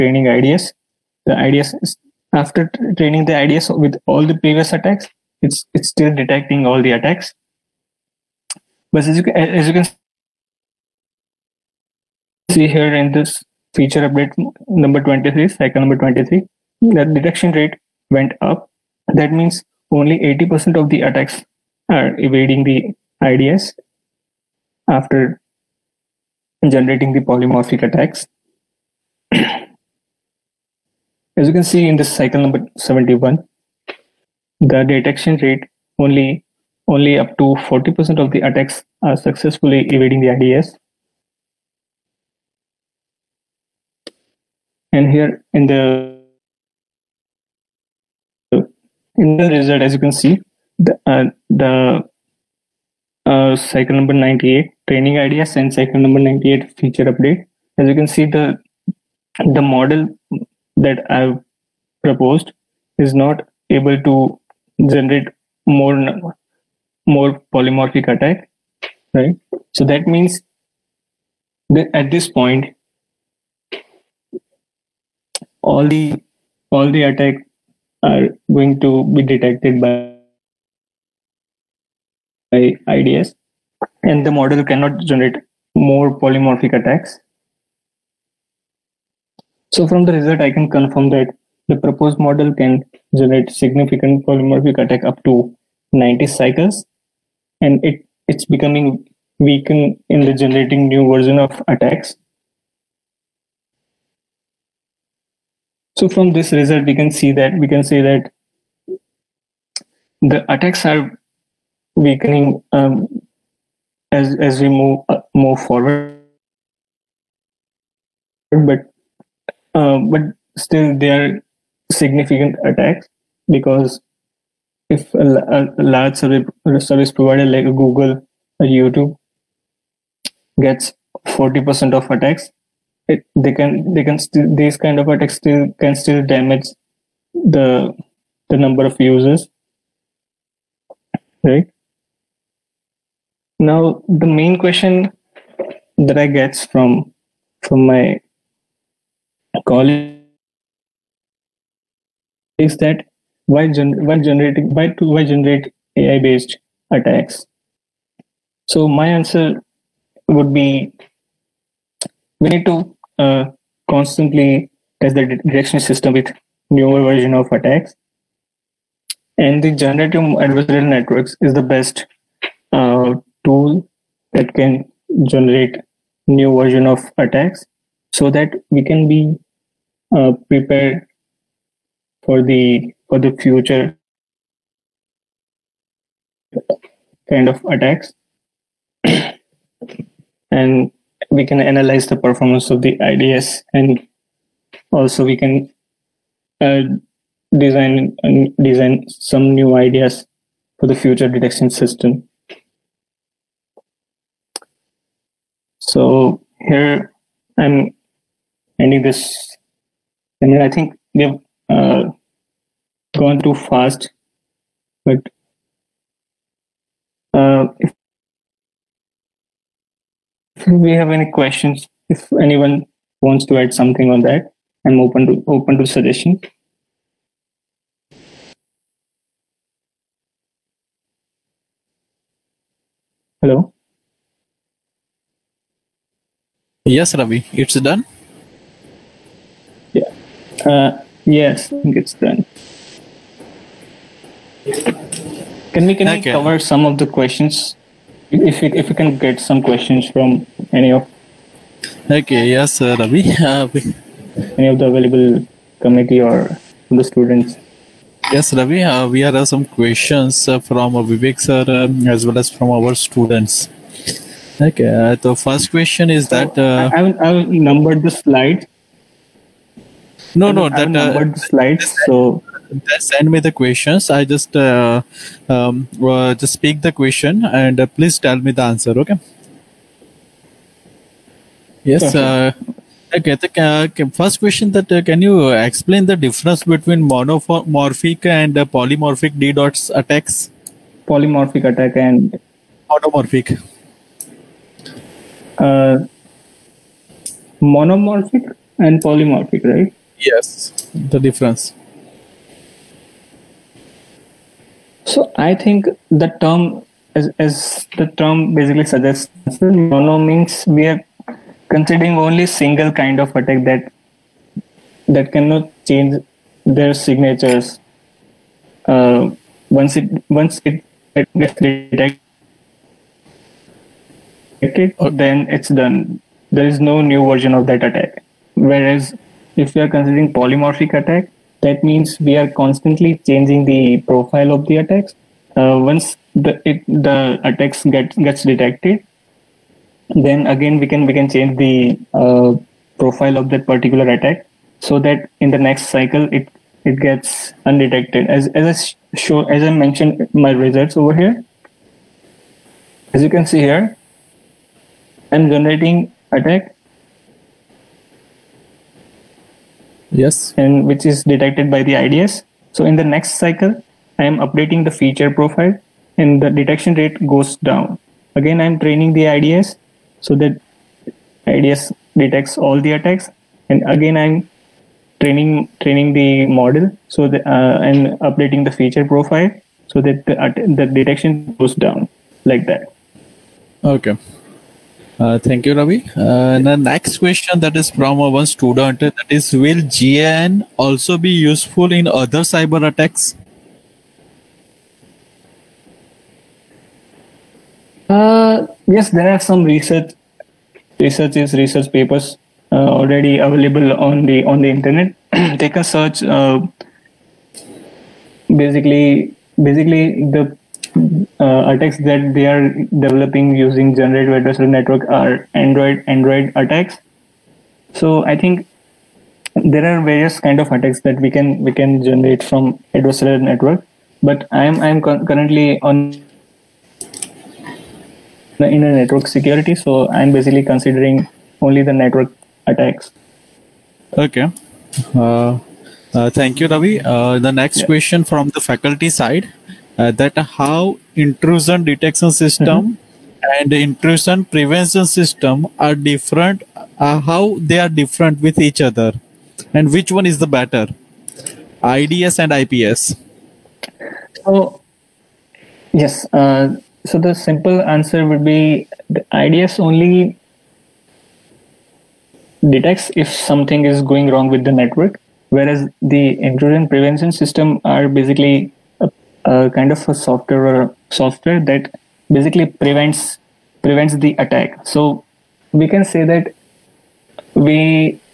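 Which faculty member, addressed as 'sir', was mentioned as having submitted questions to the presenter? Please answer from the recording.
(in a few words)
Vivek.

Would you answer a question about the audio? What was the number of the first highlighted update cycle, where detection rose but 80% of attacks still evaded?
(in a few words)
23.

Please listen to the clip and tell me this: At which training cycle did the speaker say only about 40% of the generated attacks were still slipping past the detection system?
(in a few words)
71.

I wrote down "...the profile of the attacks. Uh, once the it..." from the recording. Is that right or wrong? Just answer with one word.
right.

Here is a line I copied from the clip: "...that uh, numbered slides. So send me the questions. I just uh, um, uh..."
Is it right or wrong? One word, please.
right.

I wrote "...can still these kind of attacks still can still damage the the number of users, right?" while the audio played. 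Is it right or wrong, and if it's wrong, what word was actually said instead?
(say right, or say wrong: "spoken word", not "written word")
right.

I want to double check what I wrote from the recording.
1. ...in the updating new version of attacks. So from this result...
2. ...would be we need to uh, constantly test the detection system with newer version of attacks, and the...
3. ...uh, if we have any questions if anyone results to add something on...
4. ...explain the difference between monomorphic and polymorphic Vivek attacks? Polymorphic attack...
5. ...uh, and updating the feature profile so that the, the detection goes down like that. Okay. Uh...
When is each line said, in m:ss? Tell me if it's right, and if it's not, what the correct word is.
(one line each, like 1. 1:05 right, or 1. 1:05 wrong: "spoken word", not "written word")
1. 1:40 wrong: "generating", not "updating"
2. 2:40 right
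3. 3:37 wrong: "wants", not "results"
4. 4:45 wrong: "DDoS", not "Vivek"
5. 6:17 right.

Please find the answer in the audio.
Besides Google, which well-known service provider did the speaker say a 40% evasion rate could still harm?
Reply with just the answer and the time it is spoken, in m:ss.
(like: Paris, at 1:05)
YouTube, at 2:08.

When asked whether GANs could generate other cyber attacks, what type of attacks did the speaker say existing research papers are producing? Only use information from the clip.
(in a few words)
Android attacks.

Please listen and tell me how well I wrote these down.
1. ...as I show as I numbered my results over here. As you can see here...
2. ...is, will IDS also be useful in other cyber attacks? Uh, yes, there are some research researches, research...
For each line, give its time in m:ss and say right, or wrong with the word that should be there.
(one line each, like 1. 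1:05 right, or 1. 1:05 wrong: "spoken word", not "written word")
1. 5:48 wrong: "mentioned", not "numbered"
2. 6:29 wrong: "GAN", not "IDS".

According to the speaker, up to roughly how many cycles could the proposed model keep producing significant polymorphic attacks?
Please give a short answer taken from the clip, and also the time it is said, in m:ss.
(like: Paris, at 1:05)
90, at 1:35.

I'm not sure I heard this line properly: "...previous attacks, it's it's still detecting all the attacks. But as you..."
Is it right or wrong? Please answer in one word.
right.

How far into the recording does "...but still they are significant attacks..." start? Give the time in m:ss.
1:59.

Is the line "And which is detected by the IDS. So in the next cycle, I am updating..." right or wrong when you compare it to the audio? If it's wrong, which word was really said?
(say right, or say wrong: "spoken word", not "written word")
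right.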